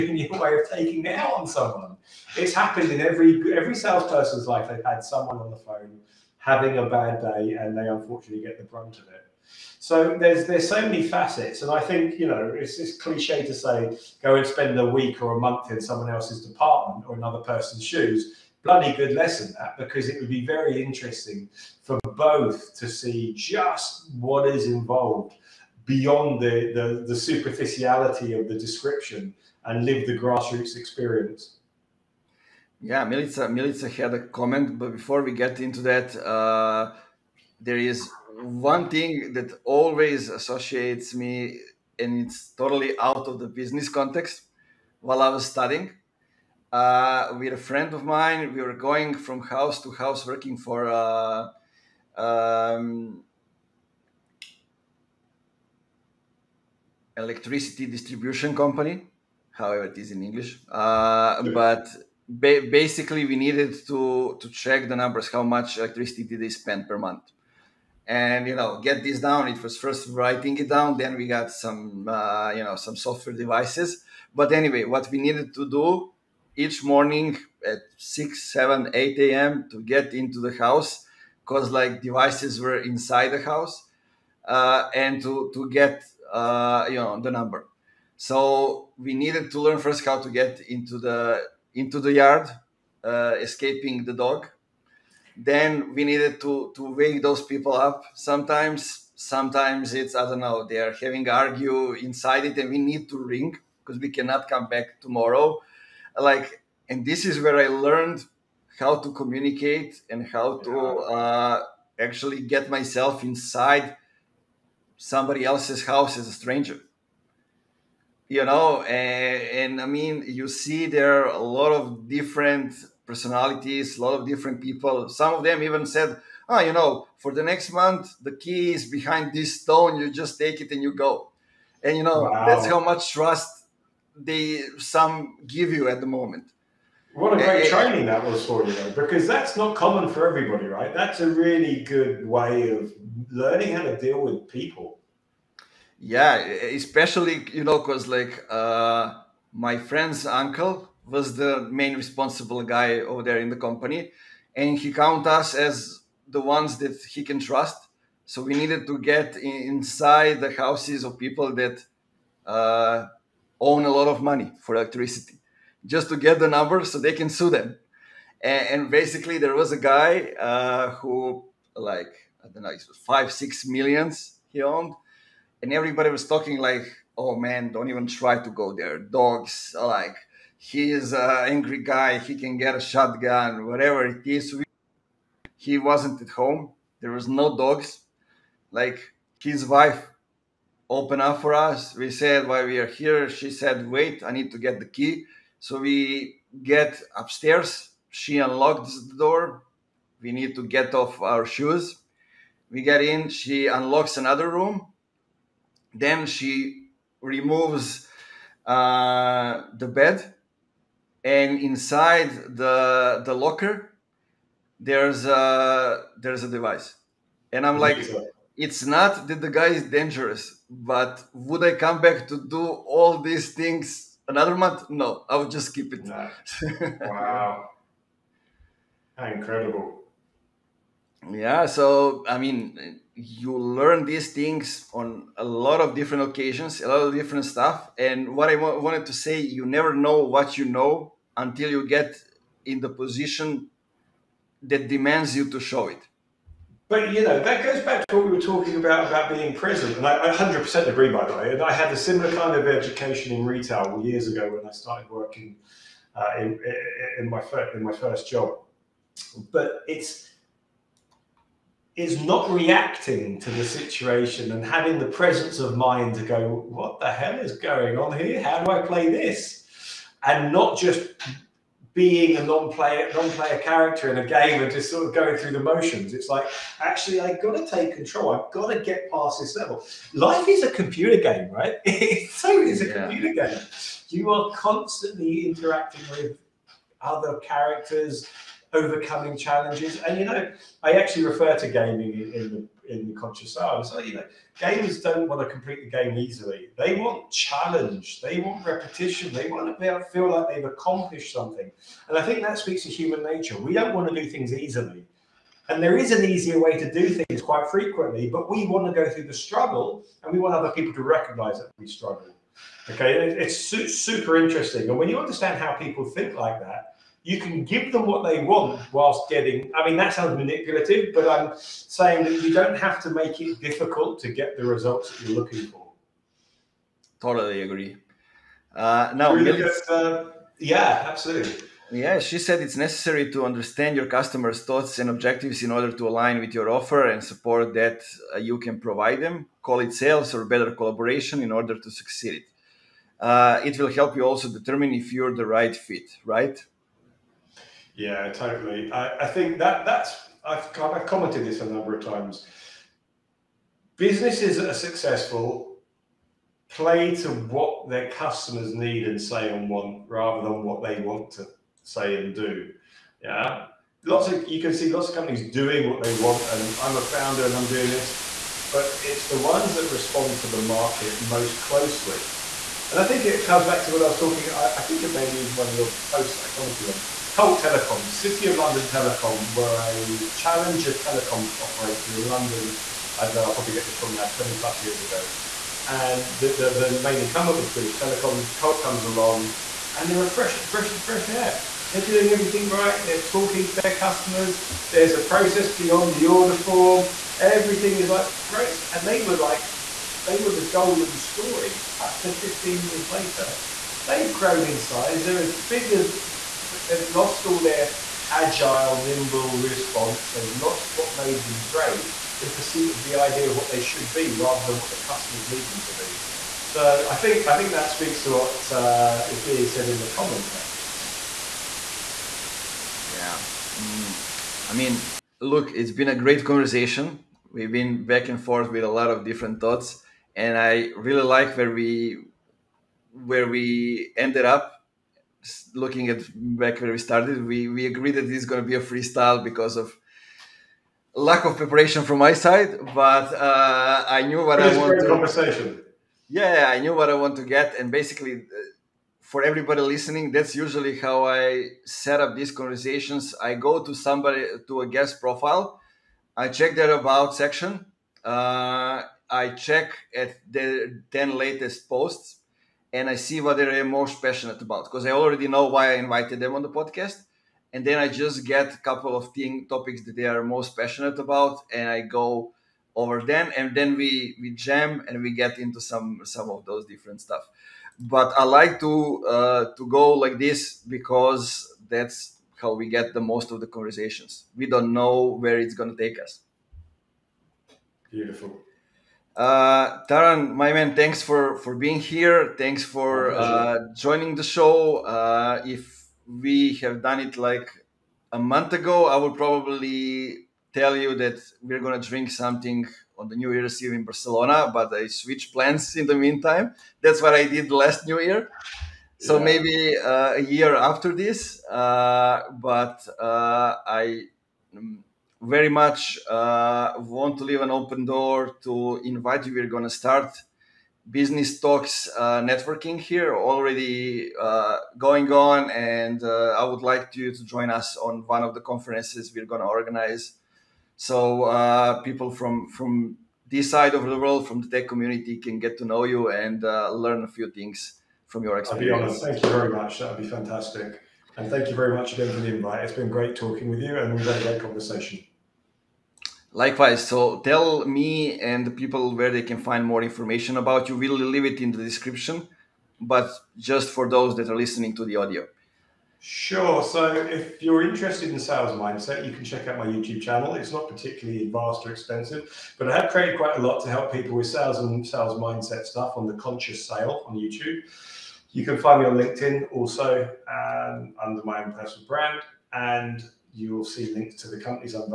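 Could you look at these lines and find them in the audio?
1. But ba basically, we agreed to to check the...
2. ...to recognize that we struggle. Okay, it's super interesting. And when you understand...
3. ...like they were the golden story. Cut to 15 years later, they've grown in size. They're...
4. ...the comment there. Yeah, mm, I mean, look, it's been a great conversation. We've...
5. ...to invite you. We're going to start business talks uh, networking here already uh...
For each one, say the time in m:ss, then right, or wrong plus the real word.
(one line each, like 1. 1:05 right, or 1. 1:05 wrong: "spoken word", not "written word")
1. 1:01 wrong: "needed", not "agreed"
2. 5:10 right
3. 6:39 right
4. 7:00 right
5. 8:38 right.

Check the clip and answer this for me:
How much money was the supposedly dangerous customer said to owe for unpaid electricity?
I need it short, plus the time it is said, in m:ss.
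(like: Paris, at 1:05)
five, six millions, at 2:52.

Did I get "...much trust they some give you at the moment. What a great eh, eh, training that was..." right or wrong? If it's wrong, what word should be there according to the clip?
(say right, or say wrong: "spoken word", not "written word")
right.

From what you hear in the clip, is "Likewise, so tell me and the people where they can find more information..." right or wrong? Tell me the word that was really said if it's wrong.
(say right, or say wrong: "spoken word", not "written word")
right.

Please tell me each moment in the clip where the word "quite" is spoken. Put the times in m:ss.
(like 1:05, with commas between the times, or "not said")
5:07, 9:23.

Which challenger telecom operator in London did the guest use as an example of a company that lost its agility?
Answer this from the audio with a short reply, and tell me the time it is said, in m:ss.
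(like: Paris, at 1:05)
Colt Telecom, at 6:17.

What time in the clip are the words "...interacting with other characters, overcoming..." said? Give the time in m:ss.
4:45.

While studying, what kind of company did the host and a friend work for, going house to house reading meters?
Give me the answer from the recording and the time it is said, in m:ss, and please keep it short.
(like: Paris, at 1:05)
electricity distribution company, at 0:57.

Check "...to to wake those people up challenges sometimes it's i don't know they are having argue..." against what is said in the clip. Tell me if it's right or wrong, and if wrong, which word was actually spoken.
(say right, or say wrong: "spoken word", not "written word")
wrong: "sometimes", not "challenges".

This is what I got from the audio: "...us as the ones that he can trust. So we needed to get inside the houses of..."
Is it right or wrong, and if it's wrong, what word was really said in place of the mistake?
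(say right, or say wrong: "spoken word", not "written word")
right.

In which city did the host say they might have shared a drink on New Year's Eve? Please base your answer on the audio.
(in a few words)
Barcelona.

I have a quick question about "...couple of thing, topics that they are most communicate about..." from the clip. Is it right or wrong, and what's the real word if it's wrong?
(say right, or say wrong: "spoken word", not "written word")
wrong: "passionate", not "communicate".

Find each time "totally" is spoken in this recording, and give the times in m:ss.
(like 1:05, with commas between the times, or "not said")
0:42, 5:27, 5:48.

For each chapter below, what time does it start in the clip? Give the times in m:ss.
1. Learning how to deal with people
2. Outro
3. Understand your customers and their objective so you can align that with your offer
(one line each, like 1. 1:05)
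1. 0:37
2. 7:05
3. 5:33.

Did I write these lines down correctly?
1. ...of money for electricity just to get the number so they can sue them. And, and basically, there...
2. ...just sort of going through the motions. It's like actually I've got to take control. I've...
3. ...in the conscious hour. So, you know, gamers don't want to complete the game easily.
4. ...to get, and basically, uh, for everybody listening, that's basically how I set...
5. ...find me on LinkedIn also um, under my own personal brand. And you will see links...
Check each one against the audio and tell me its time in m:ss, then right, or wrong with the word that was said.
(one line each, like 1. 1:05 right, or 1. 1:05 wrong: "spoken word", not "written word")
1. 2:44 right
2. 4:34 right
3. 4:52 right
4. 7:27 wrong: "usually", not "basically"
5. 9:28 right.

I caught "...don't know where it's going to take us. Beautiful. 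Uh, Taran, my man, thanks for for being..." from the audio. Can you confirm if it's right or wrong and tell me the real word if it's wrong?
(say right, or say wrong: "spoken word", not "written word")
right.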